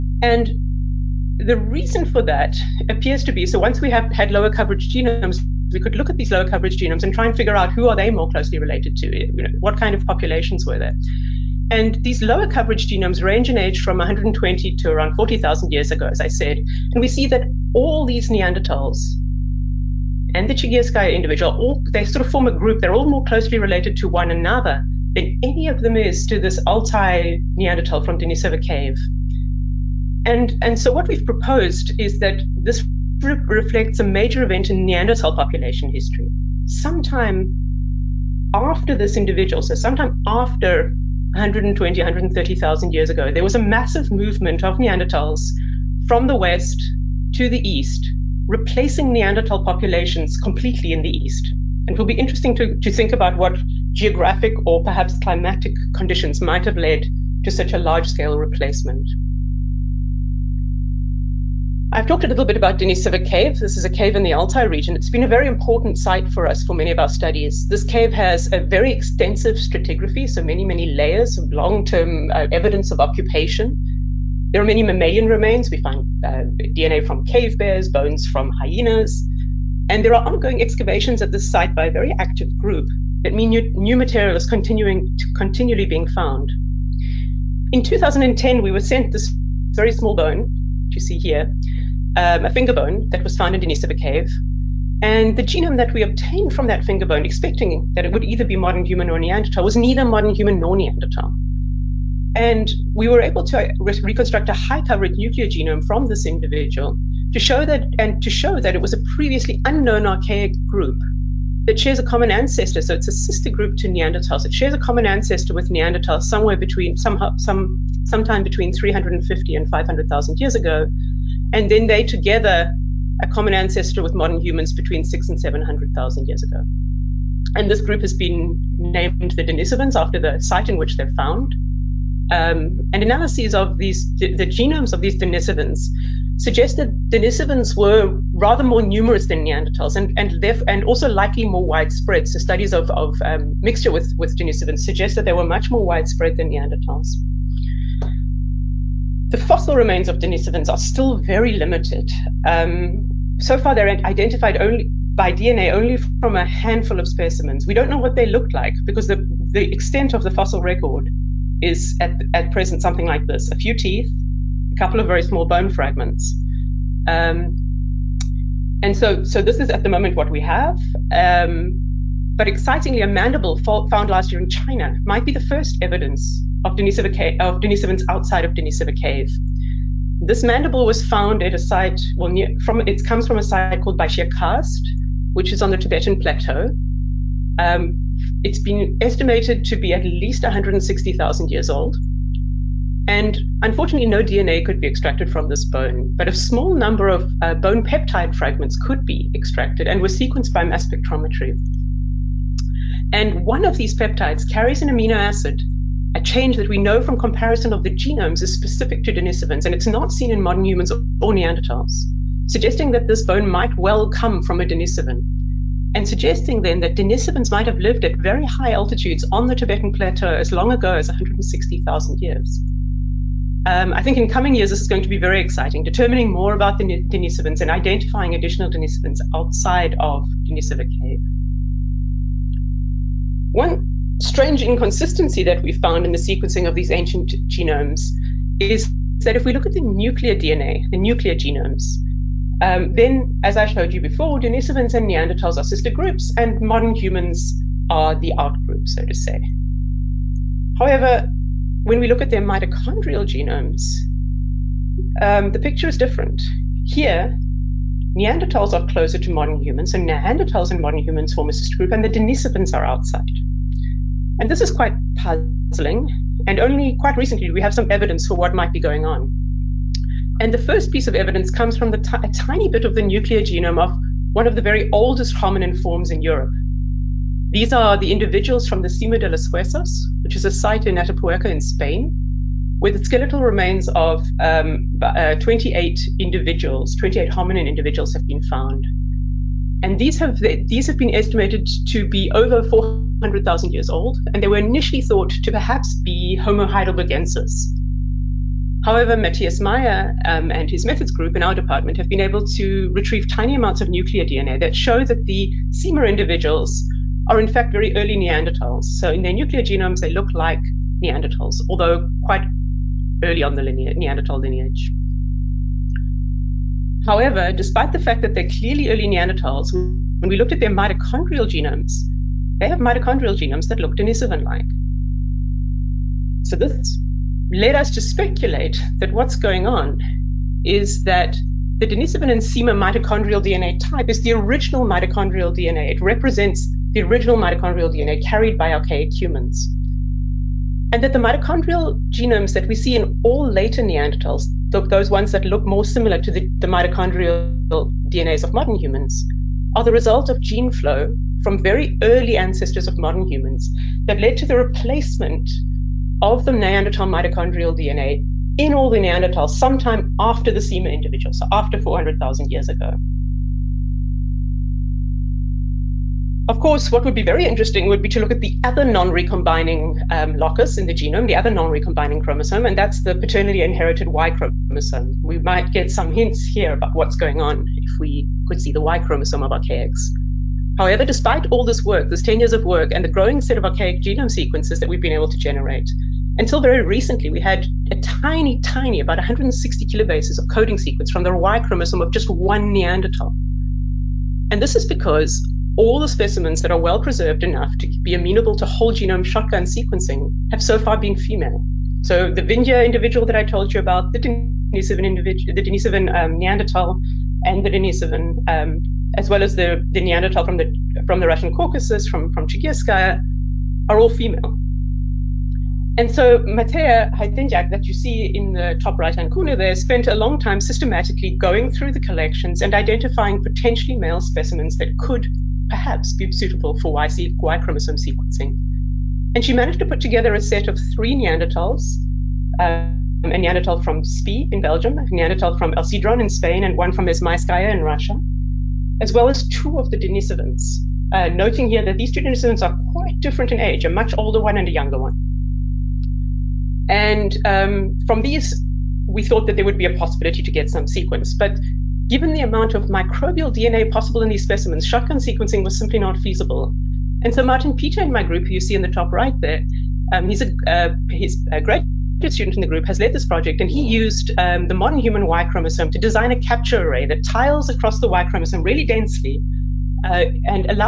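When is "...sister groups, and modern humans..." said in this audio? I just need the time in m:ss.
4:05.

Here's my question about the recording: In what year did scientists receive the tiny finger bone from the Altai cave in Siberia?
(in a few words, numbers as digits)
2010.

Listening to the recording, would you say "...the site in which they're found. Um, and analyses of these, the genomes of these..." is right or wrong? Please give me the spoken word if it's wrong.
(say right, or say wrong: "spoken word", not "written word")
right.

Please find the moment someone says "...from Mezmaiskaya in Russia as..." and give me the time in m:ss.
7:16.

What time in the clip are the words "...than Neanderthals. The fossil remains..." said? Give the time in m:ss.
2:26.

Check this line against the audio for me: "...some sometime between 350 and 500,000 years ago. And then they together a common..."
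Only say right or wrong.
right.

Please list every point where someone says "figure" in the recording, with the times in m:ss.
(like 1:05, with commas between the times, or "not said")
0:07.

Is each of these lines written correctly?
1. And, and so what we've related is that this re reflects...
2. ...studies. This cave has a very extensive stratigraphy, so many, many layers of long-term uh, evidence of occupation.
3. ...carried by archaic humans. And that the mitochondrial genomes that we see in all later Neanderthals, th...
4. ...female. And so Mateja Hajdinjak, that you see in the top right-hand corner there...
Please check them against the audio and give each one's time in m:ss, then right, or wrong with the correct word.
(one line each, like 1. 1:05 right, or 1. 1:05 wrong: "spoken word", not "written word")
1. 0:30 wrong: "proposed", not "related"
2. 1:07 right
3. 5:38 right
4. 6:54 right.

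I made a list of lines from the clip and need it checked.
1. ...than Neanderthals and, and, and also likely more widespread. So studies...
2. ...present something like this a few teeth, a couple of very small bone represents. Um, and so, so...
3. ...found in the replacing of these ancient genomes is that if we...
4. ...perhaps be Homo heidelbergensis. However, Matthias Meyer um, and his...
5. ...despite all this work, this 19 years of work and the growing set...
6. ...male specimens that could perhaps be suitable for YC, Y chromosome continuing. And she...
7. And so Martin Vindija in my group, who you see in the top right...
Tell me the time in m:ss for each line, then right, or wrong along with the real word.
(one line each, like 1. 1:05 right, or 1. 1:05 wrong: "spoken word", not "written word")
1. 2:19 right
2. 2:42 wrong: "fragments", not "represents"
3. 3:55 wrong: "sequencing", not "replacing"
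4. 4:55 right
5. 6:21 wrong: "10", not "19"
6. 7:03 wrong: "sequencing", not "continuing"
7. 7:37 wrong: "Petr", not "Vindija".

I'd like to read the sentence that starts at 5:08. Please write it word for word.
So in their nuclear genomes, they look like Neanderthals, although quite early on the lineage, Neanderthal lineage.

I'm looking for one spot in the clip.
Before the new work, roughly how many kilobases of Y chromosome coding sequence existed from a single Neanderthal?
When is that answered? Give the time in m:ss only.
6:29.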